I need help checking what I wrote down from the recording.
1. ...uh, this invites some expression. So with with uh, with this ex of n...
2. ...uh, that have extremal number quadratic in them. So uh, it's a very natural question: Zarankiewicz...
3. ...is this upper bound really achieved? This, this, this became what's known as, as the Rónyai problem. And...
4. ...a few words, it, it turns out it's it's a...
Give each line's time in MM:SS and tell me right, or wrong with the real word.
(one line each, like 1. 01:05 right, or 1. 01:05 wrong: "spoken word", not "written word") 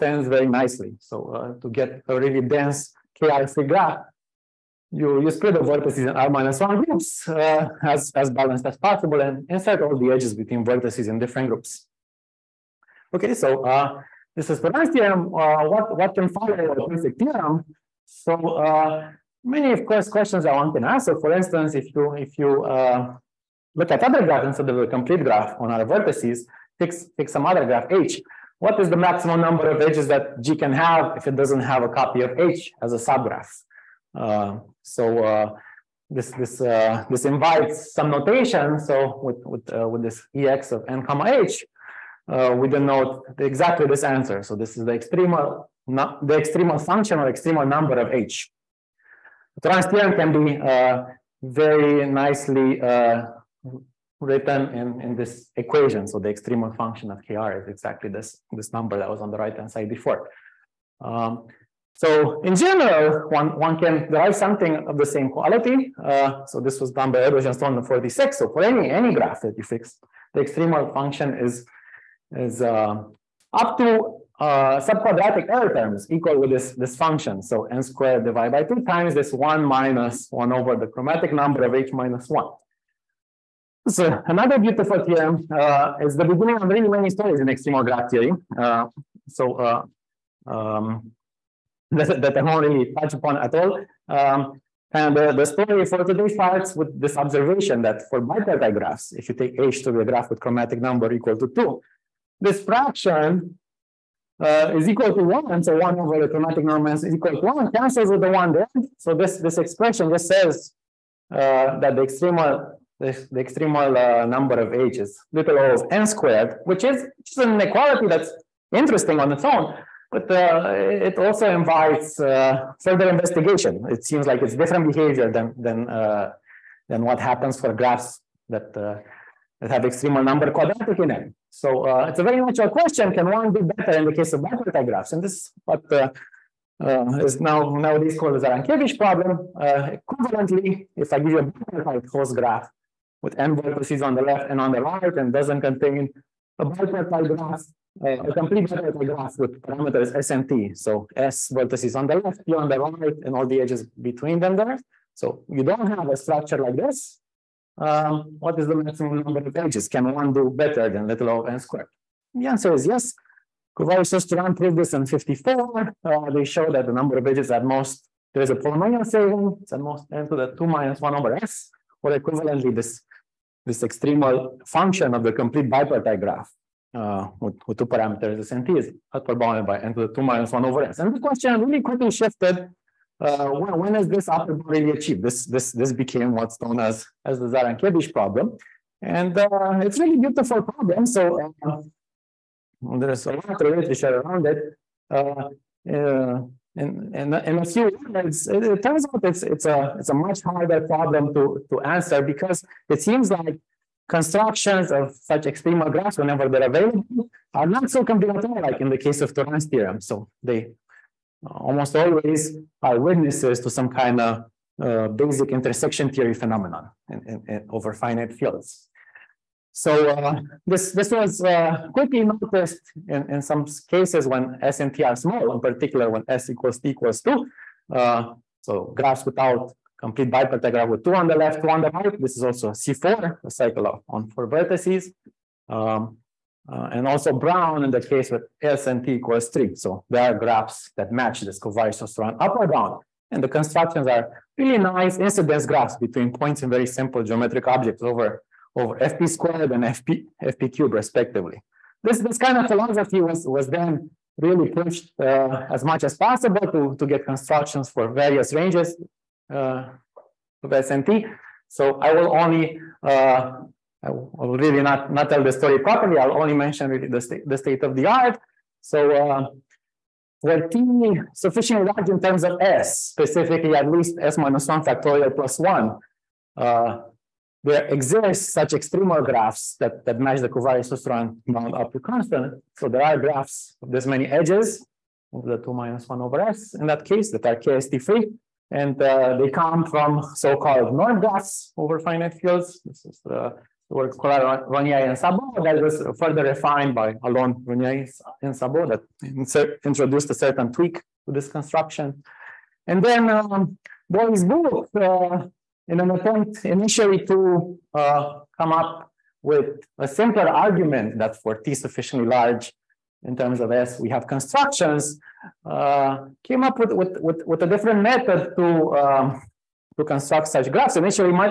1. 00:36 wrong: "notation", not "expression"
2. 02:08 wrong: "Can", not "Zarankiewicz"
3. 03:03 wrong: "Zarankiewicz", not "Rónyai"
4. 03:17 right.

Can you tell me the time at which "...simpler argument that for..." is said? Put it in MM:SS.
05:10.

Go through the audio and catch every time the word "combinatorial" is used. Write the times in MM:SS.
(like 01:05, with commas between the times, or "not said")
03:28.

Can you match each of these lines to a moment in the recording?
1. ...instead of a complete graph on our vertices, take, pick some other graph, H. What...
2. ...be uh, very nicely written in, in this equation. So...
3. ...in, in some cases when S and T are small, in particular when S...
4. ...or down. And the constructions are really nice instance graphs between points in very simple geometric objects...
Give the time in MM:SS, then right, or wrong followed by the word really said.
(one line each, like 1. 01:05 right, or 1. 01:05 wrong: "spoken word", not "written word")
1. 00:24 right
2. 00:50 right
3. 03:43 right
4. 04:02 wrong: "incidence", not "instance".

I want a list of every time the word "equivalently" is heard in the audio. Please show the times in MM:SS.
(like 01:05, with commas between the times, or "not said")
02:20, 02:52.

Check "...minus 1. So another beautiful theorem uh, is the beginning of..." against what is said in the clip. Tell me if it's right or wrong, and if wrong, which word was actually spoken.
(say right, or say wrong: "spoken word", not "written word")
right.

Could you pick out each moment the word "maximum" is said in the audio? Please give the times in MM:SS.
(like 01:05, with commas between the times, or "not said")
00:28, 02:38.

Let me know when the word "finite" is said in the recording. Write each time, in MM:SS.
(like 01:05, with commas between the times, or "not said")
03:37, 04:51.